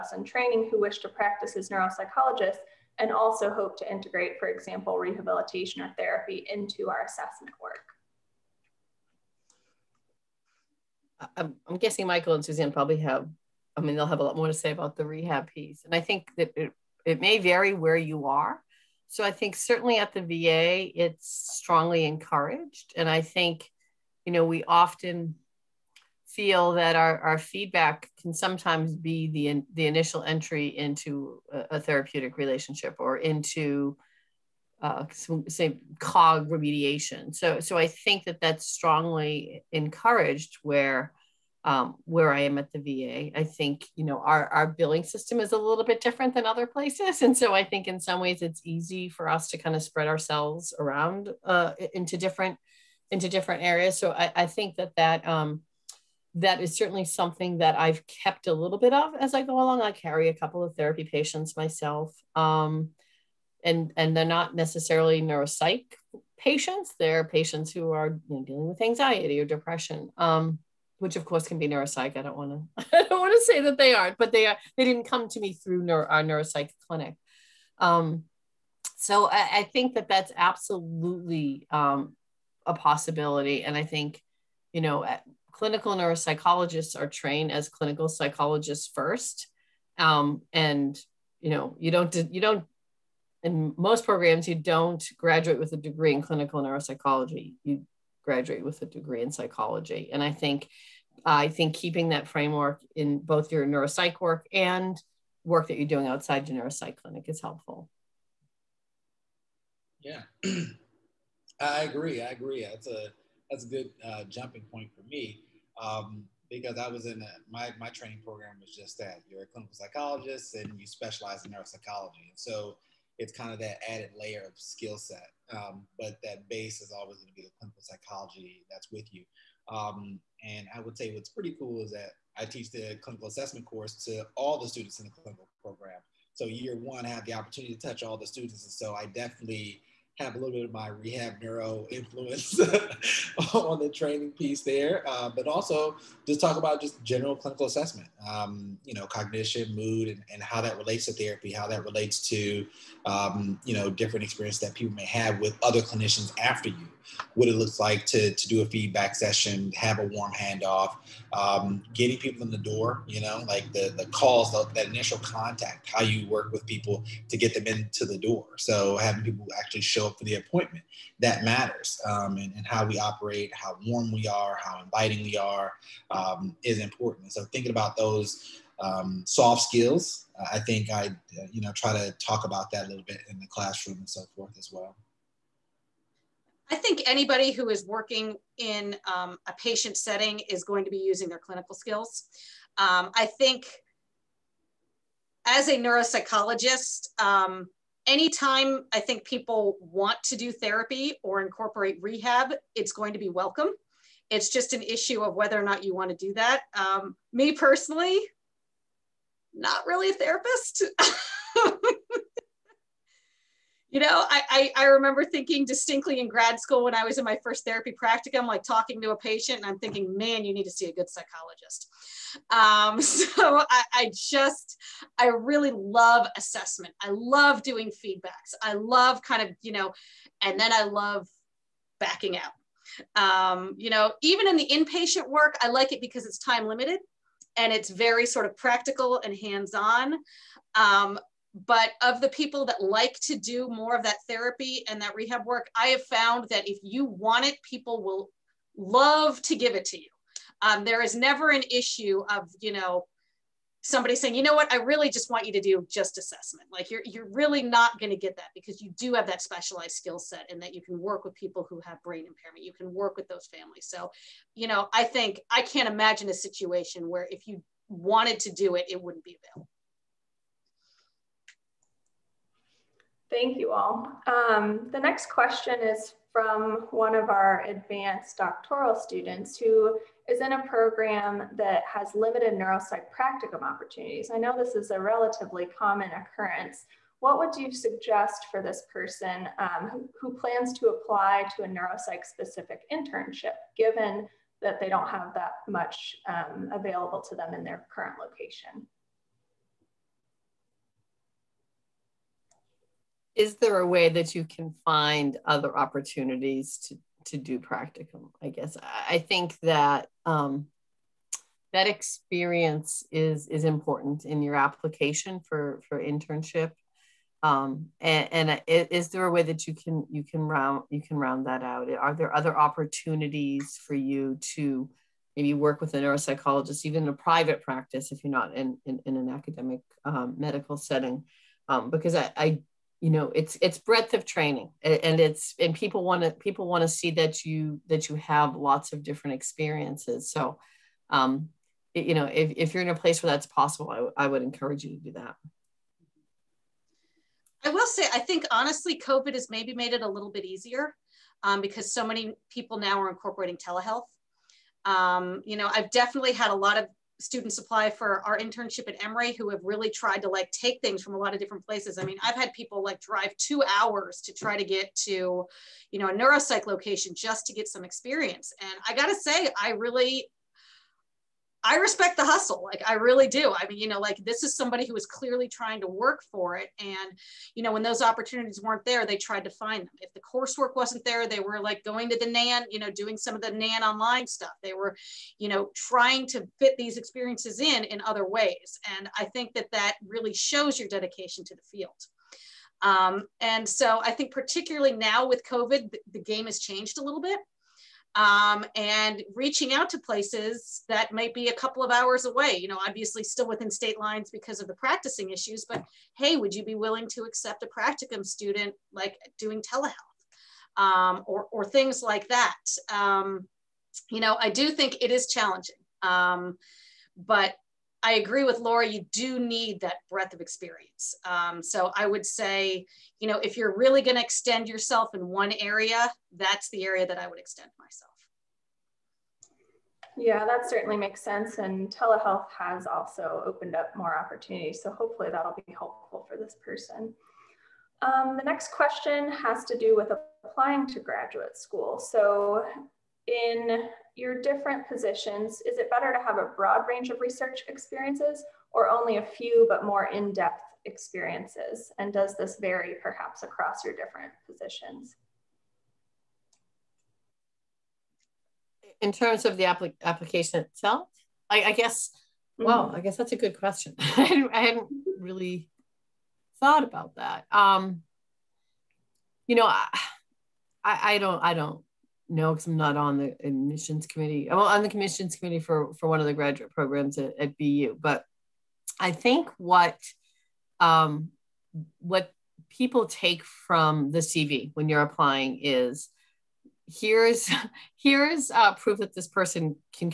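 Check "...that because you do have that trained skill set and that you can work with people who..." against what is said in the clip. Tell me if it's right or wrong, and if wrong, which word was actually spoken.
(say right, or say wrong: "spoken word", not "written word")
wrong: "specialized", not "trained".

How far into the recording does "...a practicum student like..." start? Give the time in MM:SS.
06:47.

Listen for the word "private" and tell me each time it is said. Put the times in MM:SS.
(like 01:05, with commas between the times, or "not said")
05:27.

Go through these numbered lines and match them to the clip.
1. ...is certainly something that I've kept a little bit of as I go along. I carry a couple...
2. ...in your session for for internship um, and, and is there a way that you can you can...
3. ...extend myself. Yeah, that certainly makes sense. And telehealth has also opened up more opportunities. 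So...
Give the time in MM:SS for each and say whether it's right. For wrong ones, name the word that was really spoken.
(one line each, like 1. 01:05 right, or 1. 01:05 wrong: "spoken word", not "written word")
1. 00:56 right
2. 05:14 wrong: "application", not "session"
3. 07:07 right.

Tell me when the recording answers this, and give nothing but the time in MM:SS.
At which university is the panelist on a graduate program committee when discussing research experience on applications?
07:57.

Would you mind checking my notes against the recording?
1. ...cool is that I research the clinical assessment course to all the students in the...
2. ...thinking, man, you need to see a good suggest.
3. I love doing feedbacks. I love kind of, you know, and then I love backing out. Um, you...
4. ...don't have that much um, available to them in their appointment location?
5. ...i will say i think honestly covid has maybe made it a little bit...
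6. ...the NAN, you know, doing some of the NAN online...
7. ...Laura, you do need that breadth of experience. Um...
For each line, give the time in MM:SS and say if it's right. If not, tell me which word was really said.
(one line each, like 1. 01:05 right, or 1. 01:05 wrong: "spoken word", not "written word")
1. 02:11 wrong: "teach", not "research"
2. 03:39 wrong: "psychologist", not "suggest"
3. 03:47 right
4. 04:54 wrong: "current", not "appointment"
5. 05:47 right
6. 06:22 right
7. 06:58 right.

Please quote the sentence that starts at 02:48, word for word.
So having people actually show up for the appointment, that matters.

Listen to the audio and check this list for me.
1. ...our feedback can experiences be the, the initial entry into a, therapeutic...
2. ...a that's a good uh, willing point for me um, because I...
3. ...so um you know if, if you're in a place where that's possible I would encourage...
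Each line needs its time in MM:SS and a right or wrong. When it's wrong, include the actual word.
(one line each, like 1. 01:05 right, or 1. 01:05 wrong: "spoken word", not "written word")
1. 00:27 wrong: "sometimes", not "experiences"
2. 01:52 wrong: "jumping", not "willing"
3. 05:40 right.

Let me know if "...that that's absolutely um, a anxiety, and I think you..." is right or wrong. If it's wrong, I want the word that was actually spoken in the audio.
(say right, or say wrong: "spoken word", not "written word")
wrong: "possibility", not "anxiety".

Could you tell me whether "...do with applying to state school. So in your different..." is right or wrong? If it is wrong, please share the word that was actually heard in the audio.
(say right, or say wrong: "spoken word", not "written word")
wrong: "graduate", not "state".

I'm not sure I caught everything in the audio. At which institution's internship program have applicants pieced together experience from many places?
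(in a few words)
Emory.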